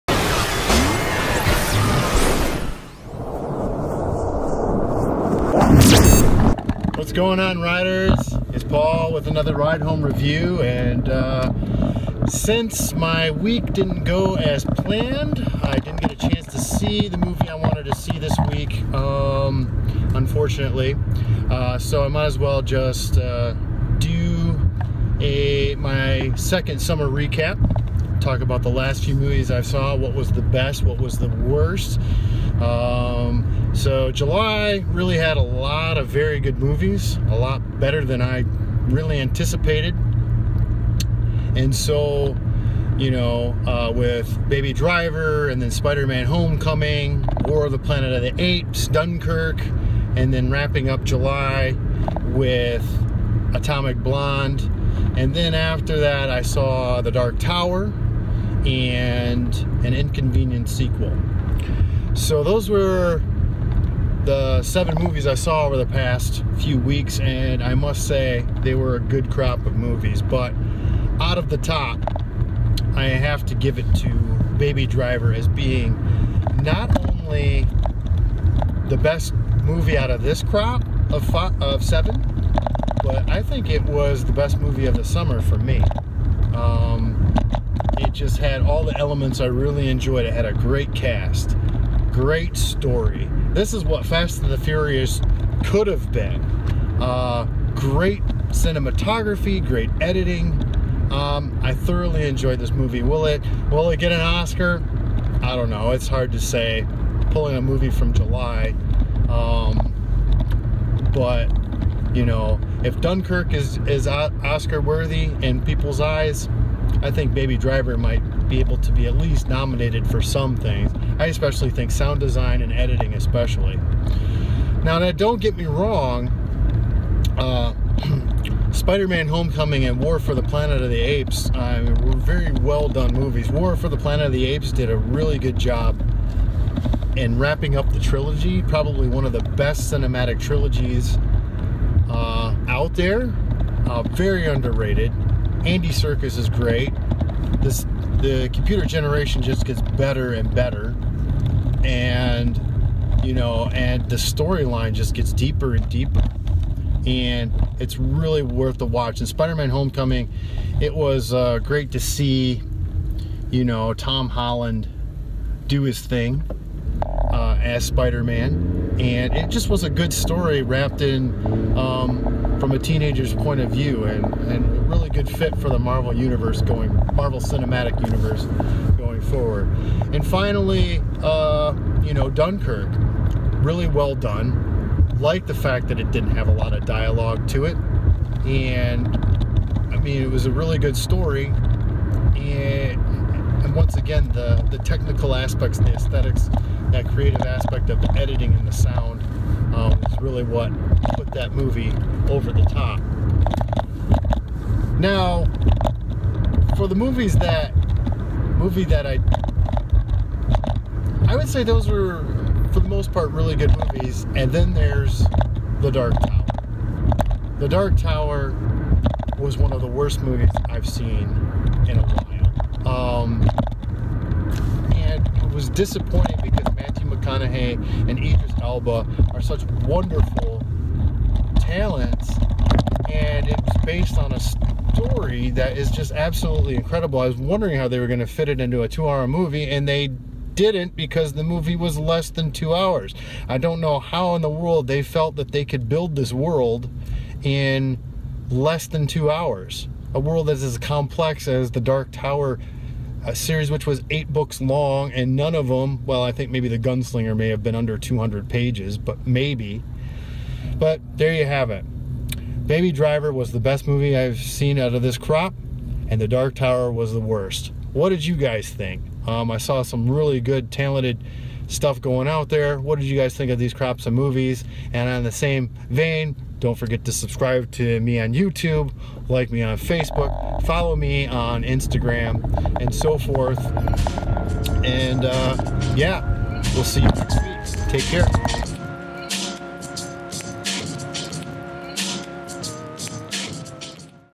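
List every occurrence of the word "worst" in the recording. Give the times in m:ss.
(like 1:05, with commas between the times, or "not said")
0:31, 3:39, 4:27.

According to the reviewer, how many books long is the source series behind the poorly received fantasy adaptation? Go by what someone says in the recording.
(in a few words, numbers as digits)
8.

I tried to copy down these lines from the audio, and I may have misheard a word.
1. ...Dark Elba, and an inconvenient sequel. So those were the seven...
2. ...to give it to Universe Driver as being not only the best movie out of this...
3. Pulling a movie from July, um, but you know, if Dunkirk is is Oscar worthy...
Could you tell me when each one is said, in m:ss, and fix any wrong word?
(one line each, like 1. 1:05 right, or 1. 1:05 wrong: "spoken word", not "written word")
1. 0:57 wrong: "Tower", not "Elba"
2. 1:13 wrong: "Baby", not "Universe"
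3. 1:47 right.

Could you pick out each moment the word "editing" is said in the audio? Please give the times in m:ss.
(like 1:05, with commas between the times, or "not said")
1:40, 2:02, 3:18.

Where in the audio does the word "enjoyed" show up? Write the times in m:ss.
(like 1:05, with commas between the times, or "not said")
1:29, 1:42.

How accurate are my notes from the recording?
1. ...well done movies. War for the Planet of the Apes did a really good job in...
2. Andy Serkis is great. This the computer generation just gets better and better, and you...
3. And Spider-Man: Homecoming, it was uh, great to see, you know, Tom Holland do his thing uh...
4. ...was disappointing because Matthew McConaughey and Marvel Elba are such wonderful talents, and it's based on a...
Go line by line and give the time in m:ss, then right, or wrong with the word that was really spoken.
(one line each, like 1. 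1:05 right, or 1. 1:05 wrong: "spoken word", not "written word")
1. 2:12 right
2. 2:25 right
3. 2:39 right
4. 3:45 wrong: "Idris", not "Marvel".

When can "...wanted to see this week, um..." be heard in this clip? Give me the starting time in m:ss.
0:17.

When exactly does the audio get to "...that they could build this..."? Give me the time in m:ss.
4:05.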